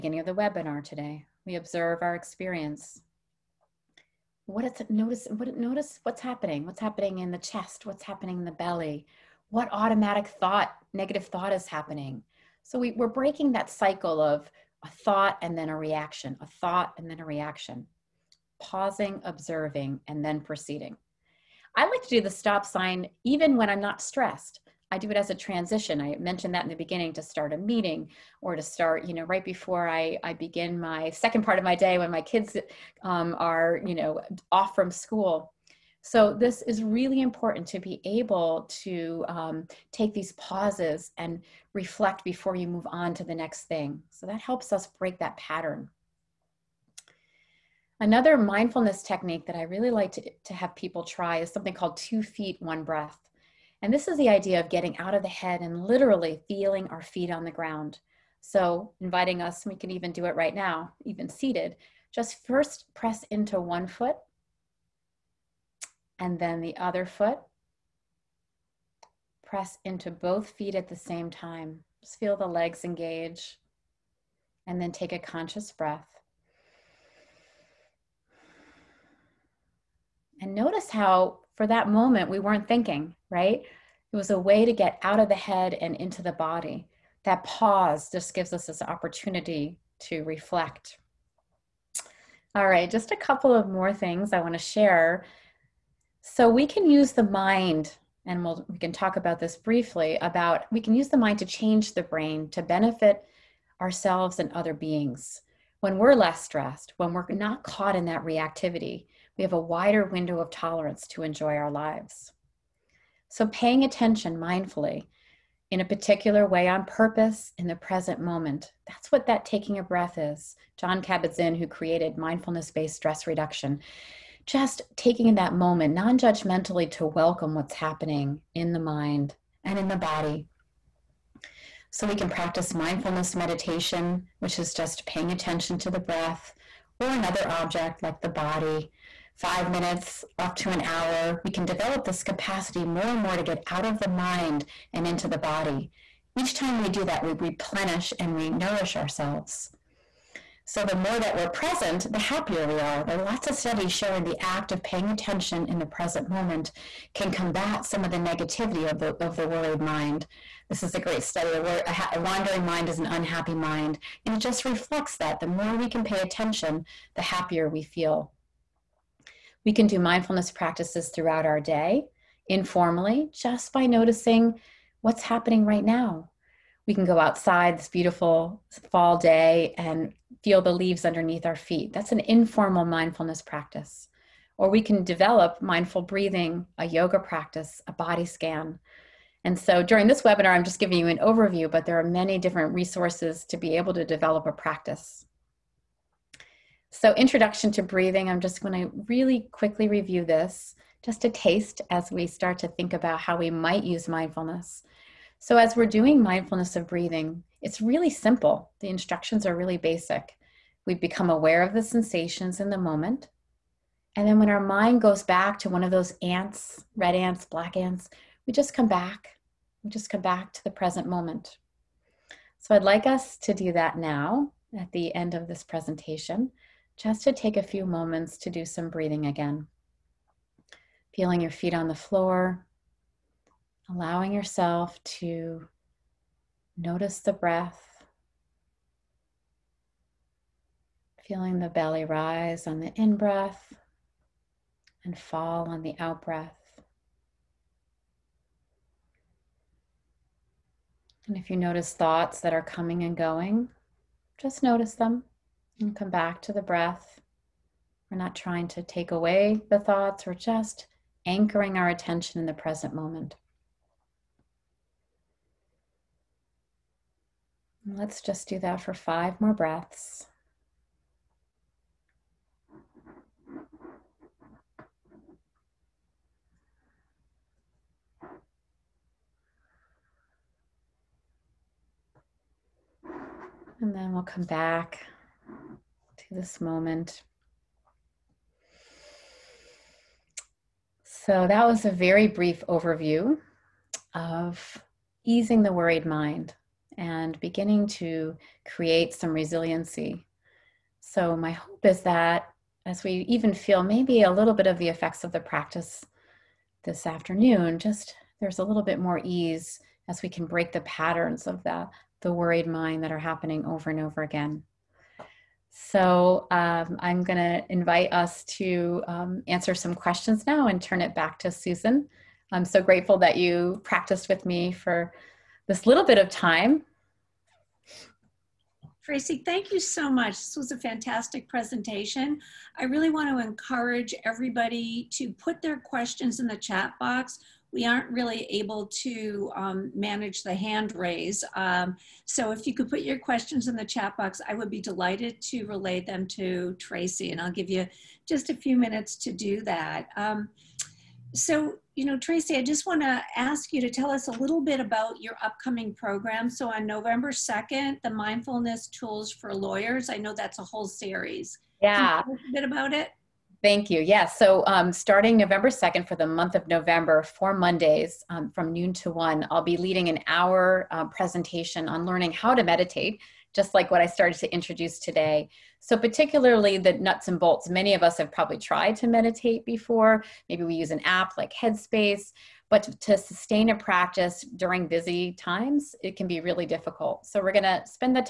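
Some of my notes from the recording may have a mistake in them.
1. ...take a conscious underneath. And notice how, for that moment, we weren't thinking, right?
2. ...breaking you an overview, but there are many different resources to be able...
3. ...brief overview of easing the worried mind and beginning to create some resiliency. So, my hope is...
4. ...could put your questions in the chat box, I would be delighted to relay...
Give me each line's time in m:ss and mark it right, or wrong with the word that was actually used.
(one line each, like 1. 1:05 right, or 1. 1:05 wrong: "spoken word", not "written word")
1. 1:14 wrong: "breath", not "underneath"
2. 3:10 wrong: "giving", not "breaking"
3. 4:52 right
4. 5:42 right.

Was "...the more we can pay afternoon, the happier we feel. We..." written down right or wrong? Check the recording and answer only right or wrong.
wrong.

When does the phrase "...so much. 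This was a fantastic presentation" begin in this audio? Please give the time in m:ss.
5:29.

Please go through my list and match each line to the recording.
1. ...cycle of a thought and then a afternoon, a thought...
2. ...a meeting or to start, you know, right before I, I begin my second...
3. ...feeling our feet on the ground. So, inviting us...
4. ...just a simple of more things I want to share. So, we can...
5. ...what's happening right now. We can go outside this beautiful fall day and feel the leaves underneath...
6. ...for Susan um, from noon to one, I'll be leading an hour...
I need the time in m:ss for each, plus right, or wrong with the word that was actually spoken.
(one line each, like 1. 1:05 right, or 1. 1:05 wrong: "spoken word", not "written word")
1. 0:13 wrong: "reaction", not "afternoon"
2. 0:27 right
3. 0:56 right
4. 1:32 wrong: "couple", not "simple"
5. 2:55 right
6. 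6:07 wrong: "Mondays", not "Susan".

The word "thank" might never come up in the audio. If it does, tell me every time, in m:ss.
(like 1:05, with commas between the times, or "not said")
5:29, 6:03.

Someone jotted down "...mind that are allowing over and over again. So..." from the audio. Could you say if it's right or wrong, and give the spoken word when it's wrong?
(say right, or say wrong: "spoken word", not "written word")
wrong: "happening", not "allowing".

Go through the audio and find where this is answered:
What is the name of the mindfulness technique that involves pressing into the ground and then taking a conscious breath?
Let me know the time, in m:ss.
0:51.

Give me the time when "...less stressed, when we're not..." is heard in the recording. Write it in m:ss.
1:46.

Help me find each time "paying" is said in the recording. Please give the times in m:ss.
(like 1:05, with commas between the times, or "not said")
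1:53, 2:15, 2:34.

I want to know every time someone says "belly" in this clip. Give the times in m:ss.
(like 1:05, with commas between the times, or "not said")
0:08, 4:01.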